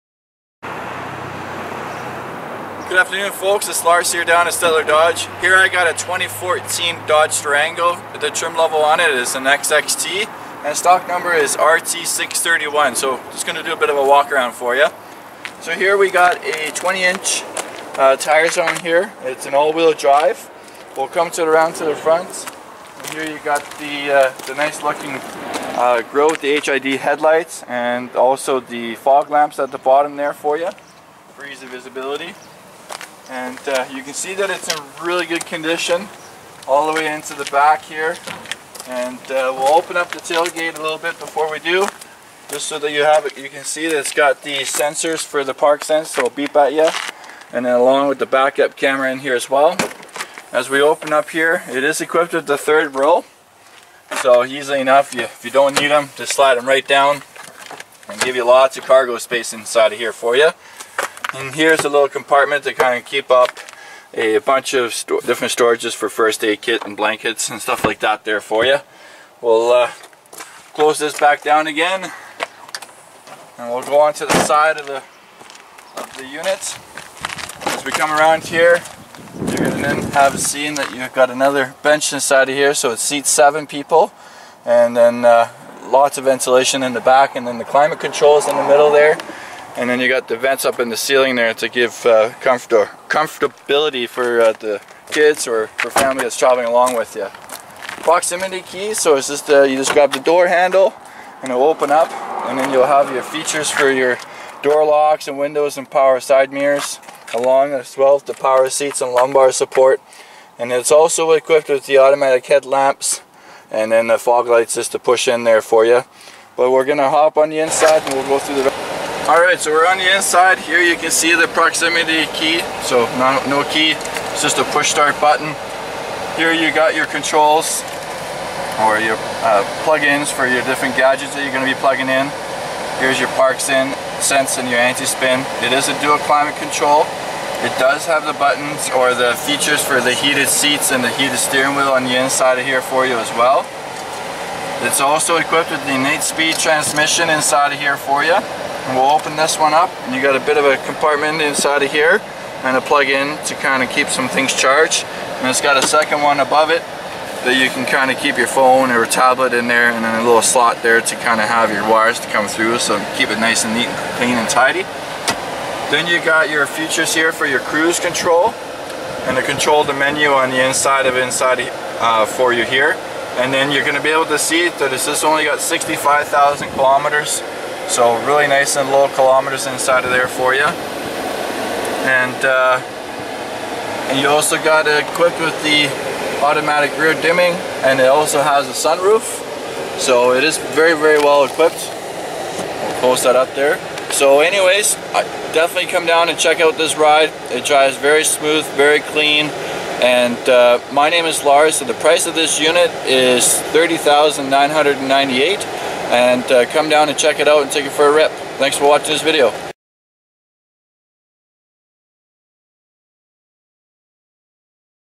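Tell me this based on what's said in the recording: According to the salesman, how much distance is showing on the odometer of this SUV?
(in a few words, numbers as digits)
65,000 kilometers.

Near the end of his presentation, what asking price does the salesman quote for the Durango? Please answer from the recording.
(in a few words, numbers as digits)
$30,998.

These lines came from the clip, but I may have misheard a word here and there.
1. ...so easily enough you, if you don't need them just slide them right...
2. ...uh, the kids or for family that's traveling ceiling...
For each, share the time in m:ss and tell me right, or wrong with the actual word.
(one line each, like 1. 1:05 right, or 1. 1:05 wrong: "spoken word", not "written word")
1. 0:54 right
2. 1:34 wrong: "along", not "ceiling".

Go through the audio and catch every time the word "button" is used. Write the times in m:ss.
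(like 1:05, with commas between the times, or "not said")
2:05, 2:18.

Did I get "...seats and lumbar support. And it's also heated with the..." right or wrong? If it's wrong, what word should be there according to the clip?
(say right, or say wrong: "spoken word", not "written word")
wrong: "equipped", not "heated".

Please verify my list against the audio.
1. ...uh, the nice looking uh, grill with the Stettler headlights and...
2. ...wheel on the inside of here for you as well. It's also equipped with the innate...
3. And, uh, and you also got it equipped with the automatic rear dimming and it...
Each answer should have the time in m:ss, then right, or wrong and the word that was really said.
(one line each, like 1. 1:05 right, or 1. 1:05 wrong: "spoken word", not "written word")
1. 0:24 wrong: "HID", not "Stettler"
2. 2:21 right
3. 3:00 right.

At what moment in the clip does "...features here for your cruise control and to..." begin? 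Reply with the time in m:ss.
2:46.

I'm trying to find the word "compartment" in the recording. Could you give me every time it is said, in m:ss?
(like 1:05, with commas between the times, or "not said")
1:02, 2:30.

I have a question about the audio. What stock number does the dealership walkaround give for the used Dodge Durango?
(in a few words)
RT631.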